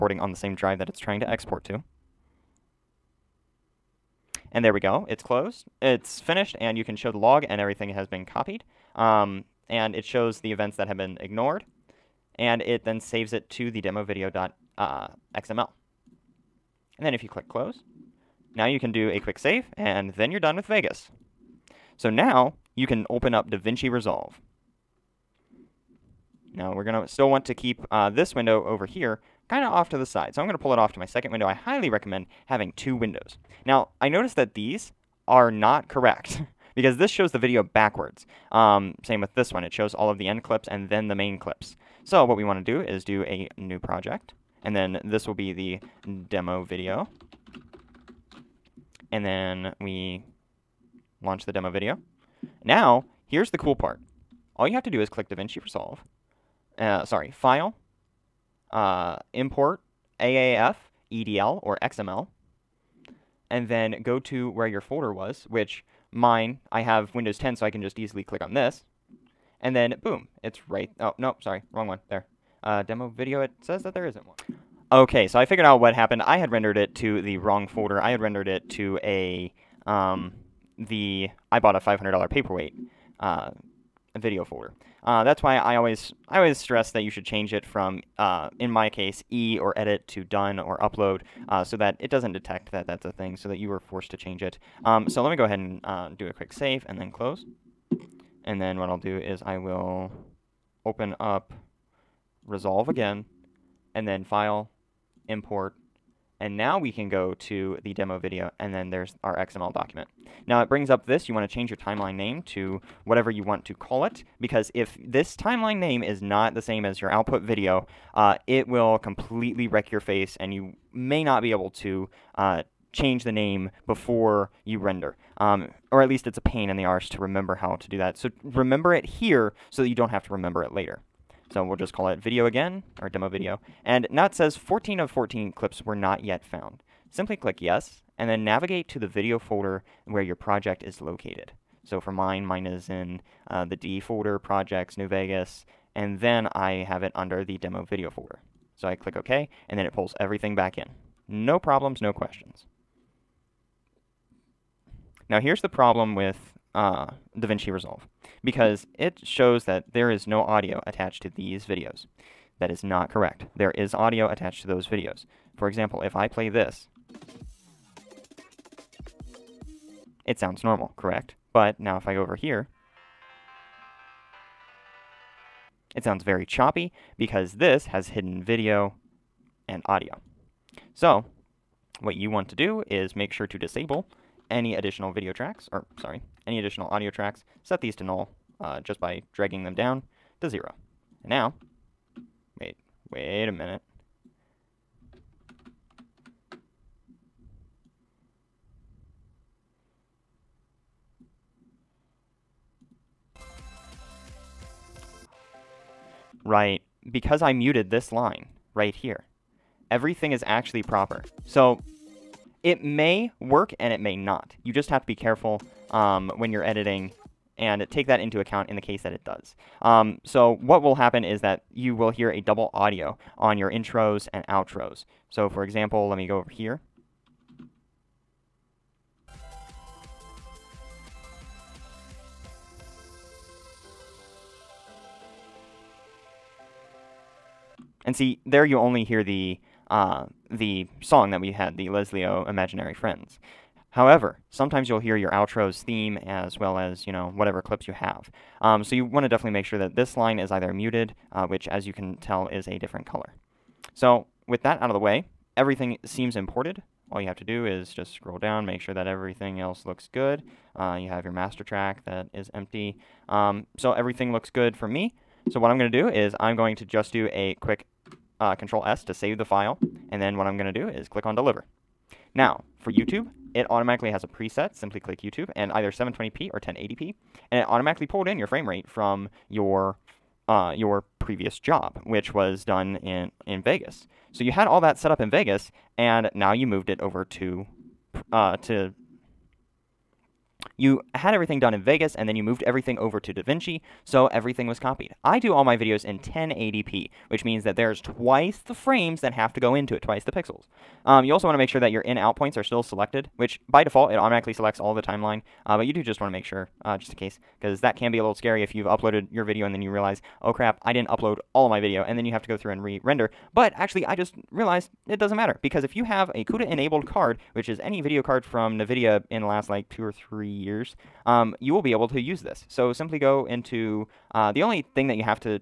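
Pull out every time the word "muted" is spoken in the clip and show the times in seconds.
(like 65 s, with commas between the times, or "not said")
207 s, 250 s.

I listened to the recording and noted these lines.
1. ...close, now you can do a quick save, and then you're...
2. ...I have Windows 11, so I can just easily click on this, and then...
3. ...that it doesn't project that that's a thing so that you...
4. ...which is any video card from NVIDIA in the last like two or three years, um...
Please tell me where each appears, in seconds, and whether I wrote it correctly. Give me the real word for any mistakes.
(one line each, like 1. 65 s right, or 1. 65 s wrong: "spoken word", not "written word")
1. 17 s right
2. 66 s wrong: "10", not "11"
3. 91 s wrong: "detect", not "project"
4. 317 s right.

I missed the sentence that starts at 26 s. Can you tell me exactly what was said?
Now we're going to still want to keep uh, this window over here kind of off to the side.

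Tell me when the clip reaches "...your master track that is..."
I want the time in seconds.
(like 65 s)
261 s.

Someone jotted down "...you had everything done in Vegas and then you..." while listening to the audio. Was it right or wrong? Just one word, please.
right.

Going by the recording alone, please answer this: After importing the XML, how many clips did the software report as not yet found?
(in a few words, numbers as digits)
14.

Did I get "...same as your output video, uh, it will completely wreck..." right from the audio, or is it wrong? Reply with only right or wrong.
right.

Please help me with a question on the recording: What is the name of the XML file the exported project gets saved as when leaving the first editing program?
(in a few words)
demo video.xml.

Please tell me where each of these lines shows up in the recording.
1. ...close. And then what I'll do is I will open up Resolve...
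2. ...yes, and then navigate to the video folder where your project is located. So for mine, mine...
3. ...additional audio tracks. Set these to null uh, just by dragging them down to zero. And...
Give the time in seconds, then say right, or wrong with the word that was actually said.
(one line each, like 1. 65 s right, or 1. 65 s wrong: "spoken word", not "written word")
1. 97 s right
2. 137 s right
3. 186 s right.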